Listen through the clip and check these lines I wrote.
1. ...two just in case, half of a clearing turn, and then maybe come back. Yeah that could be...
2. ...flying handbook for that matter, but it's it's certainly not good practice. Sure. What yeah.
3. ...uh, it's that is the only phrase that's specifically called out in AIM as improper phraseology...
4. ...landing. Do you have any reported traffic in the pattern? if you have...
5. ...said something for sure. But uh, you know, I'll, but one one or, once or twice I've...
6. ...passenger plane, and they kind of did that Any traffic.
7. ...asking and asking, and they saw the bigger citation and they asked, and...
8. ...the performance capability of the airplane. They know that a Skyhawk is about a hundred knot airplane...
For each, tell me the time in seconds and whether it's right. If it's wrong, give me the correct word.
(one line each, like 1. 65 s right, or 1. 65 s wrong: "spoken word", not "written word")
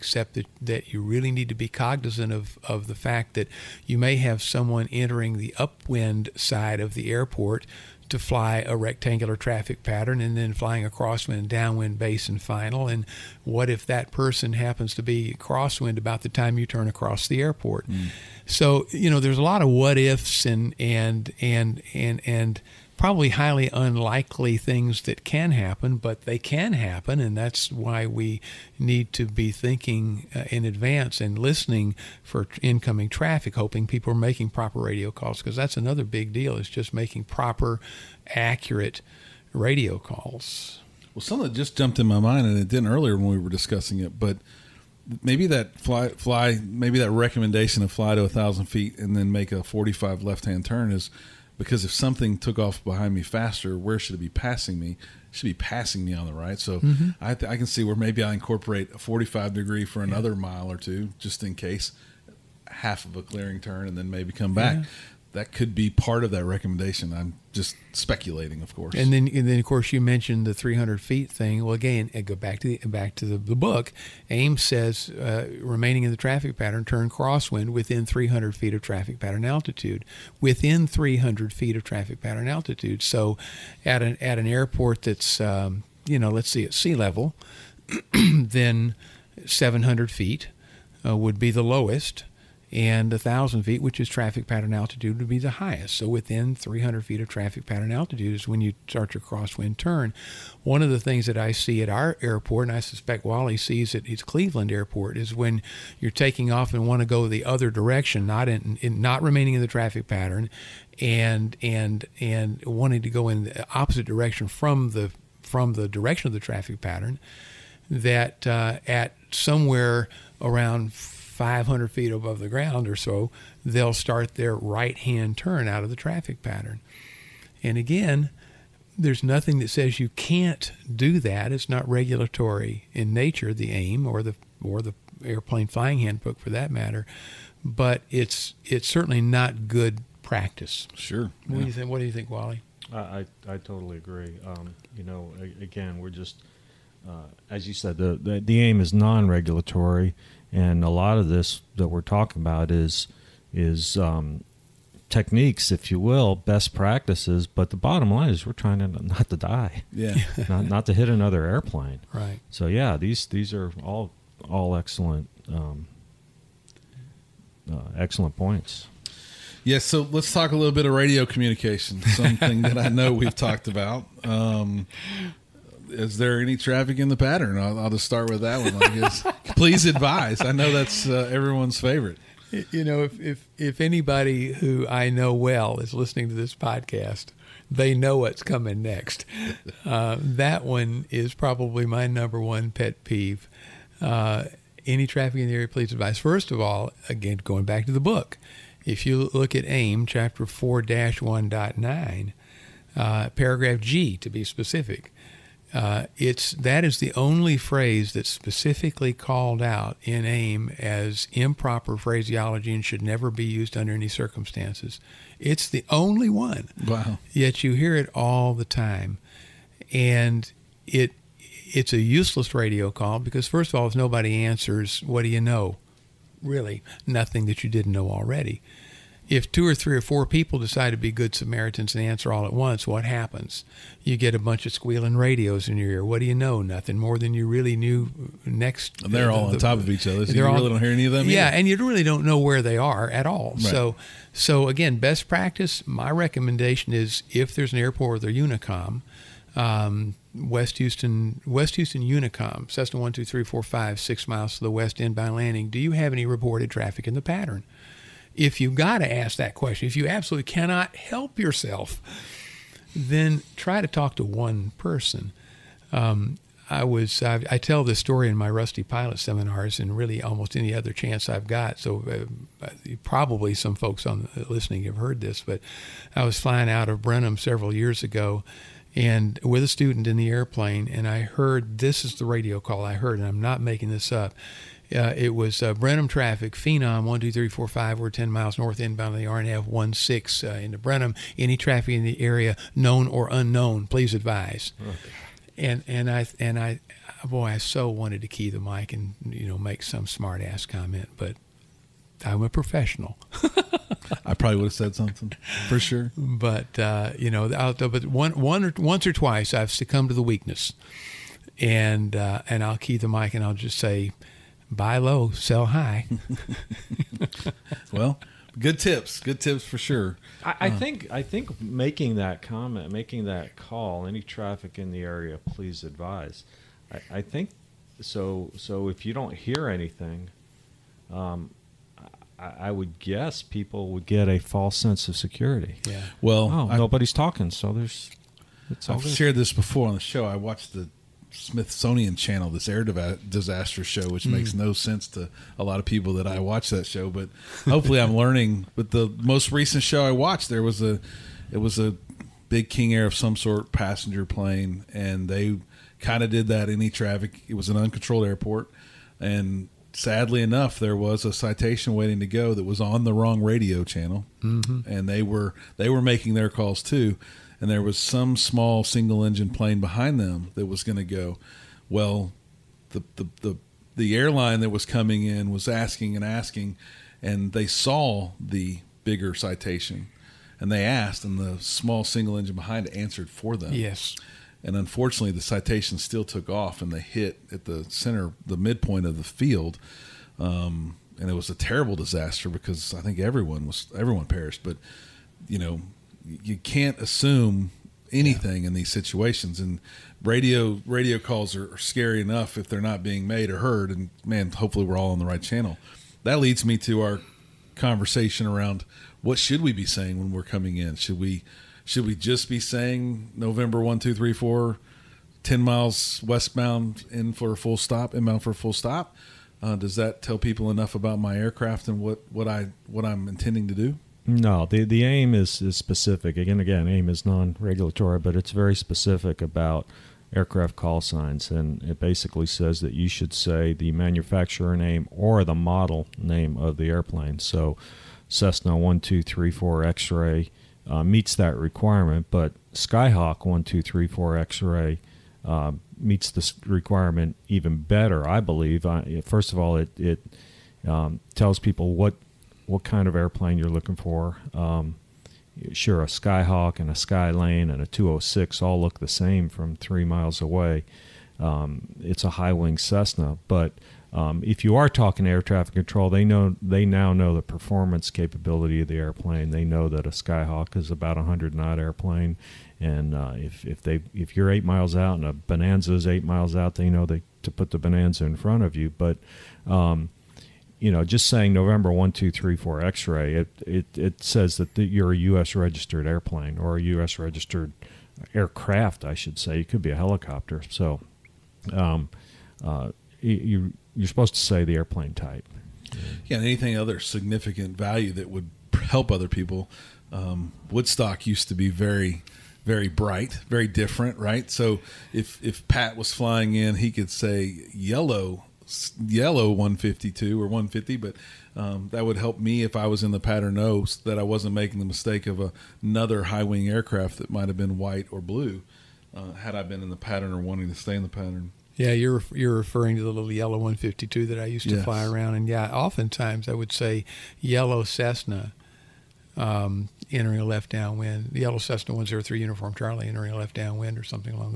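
1. 60 s right
2. 135 s right
3. 205 s right
4. 255 s right
5. 304 s right
6. 353 s right
7. 375 s right
8. 467 s right.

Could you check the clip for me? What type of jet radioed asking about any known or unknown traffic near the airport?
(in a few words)
Phenom.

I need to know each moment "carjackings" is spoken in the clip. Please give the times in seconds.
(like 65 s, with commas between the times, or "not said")
not said.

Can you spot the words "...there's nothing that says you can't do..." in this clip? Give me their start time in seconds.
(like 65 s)
128 s.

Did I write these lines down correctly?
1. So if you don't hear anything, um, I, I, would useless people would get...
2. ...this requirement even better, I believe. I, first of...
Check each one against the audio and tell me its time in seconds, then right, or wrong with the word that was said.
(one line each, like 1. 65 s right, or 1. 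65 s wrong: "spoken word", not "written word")
1. 328 s wrong: "guess", not "useless"
2. 446 s right.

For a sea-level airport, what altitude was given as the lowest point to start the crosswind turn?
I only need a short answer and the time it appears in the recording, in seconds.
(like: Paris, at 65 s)
700 feet, at 89 s.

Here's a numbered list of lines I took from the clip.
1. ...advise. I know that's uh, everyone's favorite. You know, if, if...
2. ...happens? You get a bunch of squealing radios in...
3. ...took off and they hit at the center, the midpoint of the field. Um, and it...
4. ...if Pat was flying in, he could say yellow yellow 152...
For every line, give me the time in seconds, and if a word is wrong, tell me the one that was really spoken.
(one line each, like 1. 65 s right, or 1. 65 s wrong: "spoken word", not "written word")
1. 179 s right
2. 233 s right
3. 386 s right
4. 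505 s right.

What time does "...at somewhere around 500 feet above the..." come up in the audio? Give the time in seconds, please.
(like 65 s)
118 s.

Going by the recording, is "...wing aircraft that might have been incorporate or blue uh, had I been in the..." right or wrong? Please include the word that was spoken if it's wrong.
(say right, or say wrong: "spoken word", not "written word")
wrong: "white", not "incorporate".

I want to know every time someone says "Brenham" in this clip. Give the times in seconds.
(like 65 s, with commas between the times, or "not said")
277 s, 285 s, 290 s.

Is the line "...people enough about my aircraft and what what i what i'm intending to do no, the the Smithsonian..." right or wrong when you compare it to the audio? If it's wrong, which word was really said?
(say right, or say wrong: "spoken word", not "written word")
wrong: "AIM", not "Smithsonian".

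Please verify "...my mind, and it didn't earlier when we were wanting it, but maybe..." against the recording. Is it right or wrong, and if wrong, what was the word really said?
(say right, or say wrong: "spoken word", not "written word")
wrong: "discussing", not "wanting".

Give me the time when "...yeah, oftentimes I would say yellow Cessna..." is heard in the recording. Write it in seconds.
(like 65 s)
525 s.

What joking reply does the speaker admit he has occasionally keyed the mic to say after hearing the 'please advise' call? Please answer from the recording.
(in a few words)
buy low, sell high.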